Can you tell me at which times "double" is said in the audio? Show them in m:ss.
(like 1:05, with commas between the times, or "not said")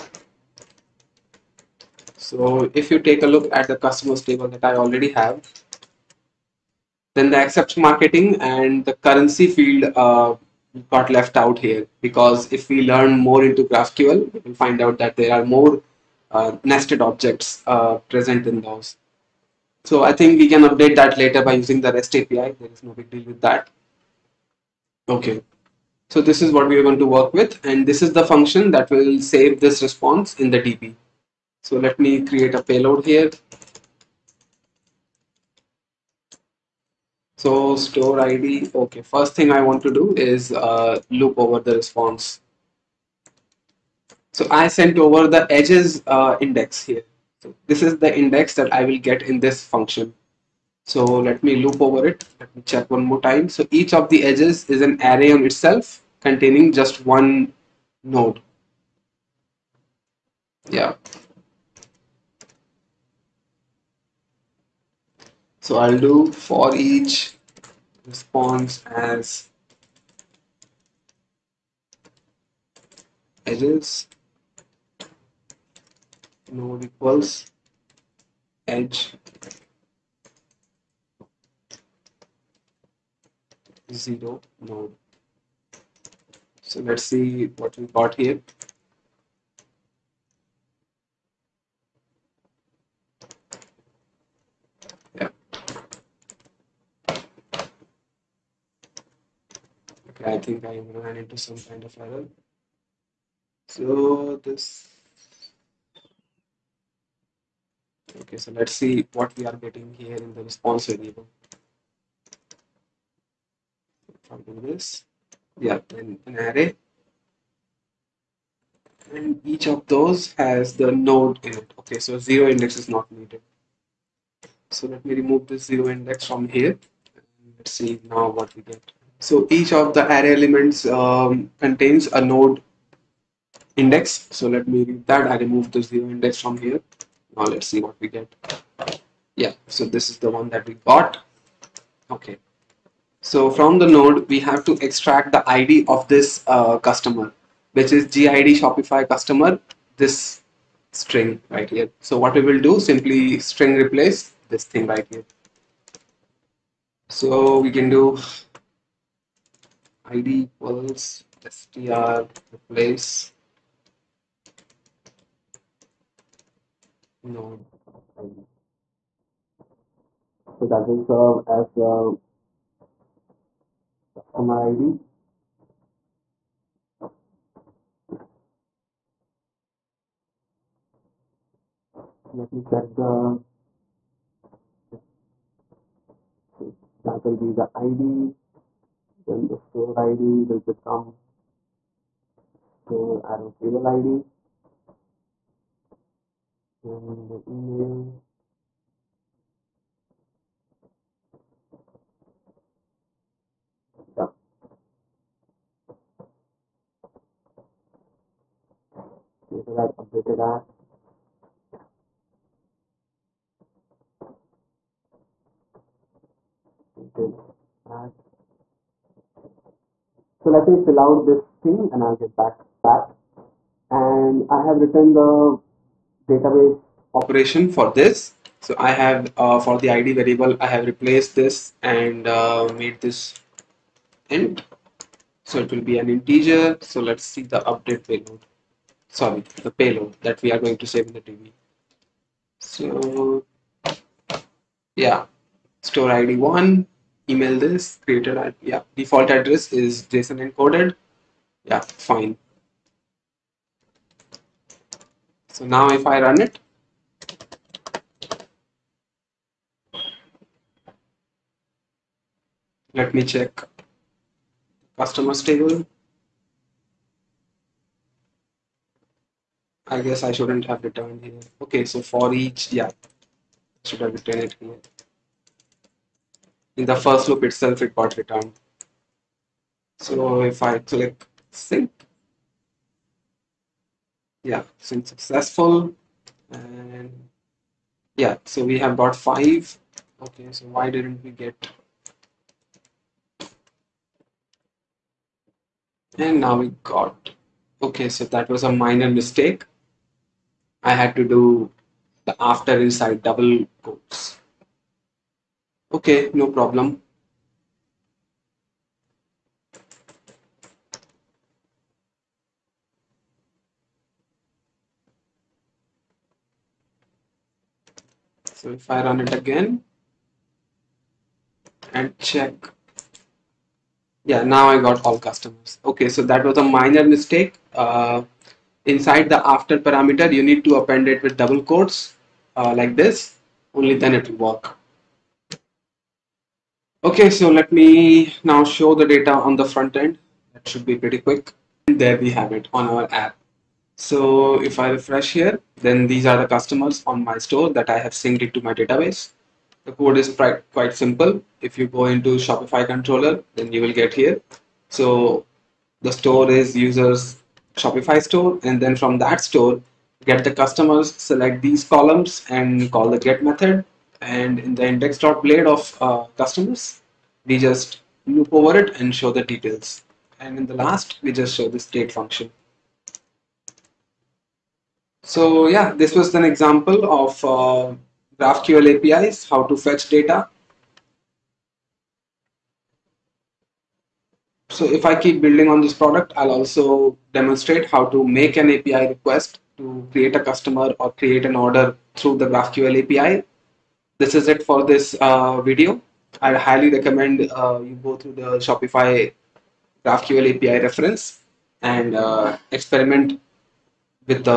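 5:03, 5:31.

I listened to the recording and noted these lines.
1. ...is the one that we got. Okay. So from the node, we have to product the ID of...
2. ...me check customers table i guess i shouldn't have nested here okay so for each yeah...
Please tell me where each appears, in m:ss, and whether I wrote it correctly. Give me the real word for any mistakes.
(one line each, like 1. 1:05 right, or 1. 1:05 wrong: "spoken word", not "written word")
1. 2:20 wrong: "extract", not "product"
2. 4:23 wrong: "returned", not "nested".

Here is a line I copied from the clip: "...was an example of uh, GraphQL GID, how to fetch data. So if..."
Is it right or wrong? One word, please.
wrong.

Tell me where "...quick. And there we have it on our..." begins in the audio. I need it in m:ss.
5:41.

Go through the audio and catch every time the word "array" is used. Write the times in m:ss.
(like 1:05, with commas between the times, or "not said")
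0:55, 1:56, 2:10.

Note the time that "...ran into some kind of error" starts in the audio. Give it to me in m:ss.
1:40.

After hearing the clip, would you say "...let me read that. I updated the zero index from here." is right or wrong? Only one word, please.
wrong.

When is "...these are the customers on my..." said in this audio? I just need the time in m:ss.
5:46.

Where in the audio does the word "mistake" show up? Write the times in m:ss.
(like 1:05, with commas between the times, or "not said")
4:59, 5:27.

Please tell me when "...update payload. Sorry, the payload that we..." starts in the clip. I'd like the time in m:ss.
3:57.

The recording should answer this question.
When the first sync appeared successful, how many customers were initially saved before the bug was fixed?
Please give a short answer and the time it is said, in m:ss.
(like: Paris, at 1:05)
5, at 4:49.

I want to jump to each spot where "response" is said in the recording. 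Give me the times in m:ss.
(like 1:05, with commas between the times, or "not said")
0:29, 0:41, 1:08, 1:50.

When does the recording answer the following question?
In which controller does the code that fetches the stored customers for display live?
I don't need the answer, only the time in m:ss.
5:52.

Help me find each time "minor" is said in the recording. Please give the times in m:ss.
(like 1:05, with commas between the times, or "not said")
4:58, 5:26.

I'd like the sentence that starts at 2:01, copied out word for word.
Okay, so zero index is not needed.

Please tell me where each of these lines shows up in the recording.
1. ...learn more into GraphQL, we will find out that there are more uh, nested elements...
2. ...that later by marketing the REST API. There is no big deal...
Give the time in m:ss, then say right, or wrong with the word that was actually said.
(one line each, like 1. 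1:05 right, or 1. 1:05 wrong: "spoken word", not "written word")
1. 0:12 wrong: "objects", not "elements"
2. 0:20 wrong: "using", not "marketing".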